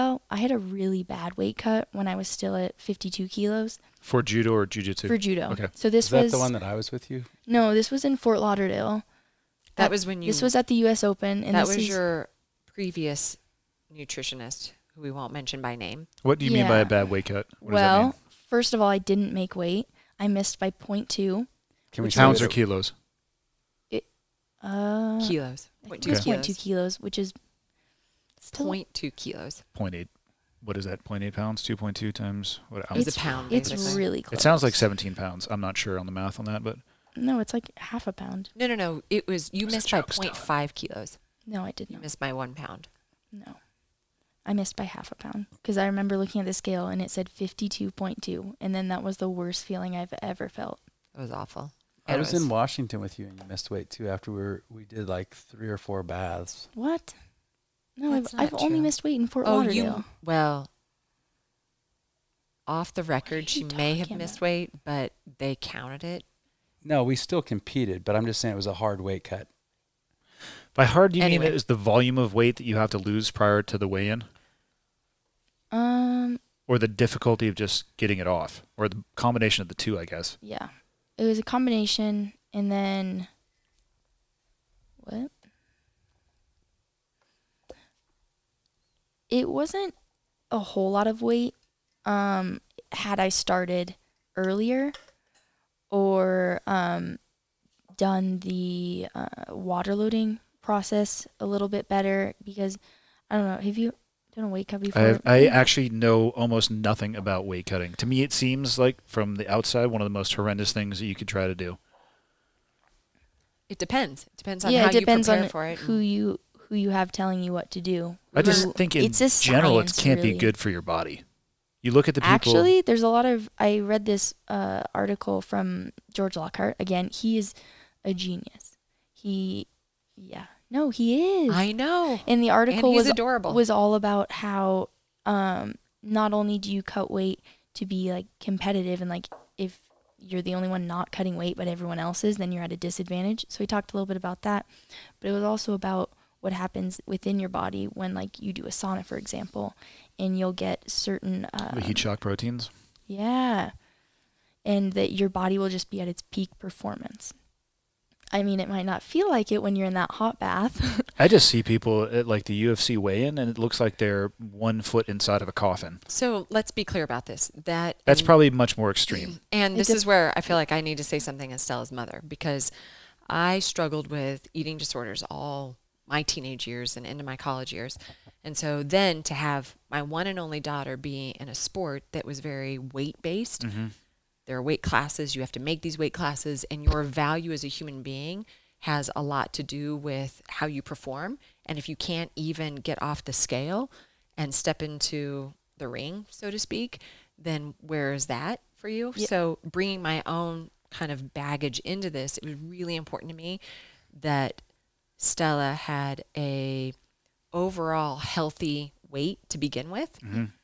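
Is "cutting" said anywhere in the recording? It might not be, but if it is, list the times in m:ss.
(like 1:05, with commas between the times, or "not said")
1:47, 2:21.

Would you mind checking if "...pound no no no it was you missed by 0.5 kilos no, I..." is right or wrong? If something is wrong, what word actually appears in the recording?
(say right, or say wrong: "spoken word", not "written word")
right.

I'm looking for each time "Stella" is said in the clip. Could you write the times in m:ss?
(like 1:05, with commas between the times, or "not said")
2:51, 3:25.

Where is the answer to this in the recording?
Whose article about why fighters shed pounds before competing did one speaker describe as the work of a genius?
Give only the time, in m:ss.
2:06.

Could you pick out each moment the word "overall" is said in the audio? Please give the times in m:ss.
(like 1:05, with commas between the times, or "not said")
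3:27.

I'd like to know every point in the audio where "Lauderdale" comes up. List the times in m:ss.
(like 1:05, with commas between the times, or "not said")
0:08, 0:59.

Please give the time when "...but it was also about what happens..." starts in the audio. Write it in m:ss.
2:25.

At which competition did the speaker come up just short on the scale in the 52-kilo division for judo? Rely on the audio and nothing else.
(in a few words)
U.S. Open.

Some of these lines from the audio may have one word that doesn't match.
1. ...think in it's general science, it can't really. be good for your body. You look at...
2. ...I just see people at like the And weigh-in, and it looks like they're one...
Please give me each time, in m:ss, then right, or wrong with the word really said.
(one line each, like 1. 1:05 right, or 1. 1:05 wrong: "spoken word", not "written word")
1. 1:58 right
2. 2:41 wrong: "UFC", not "And".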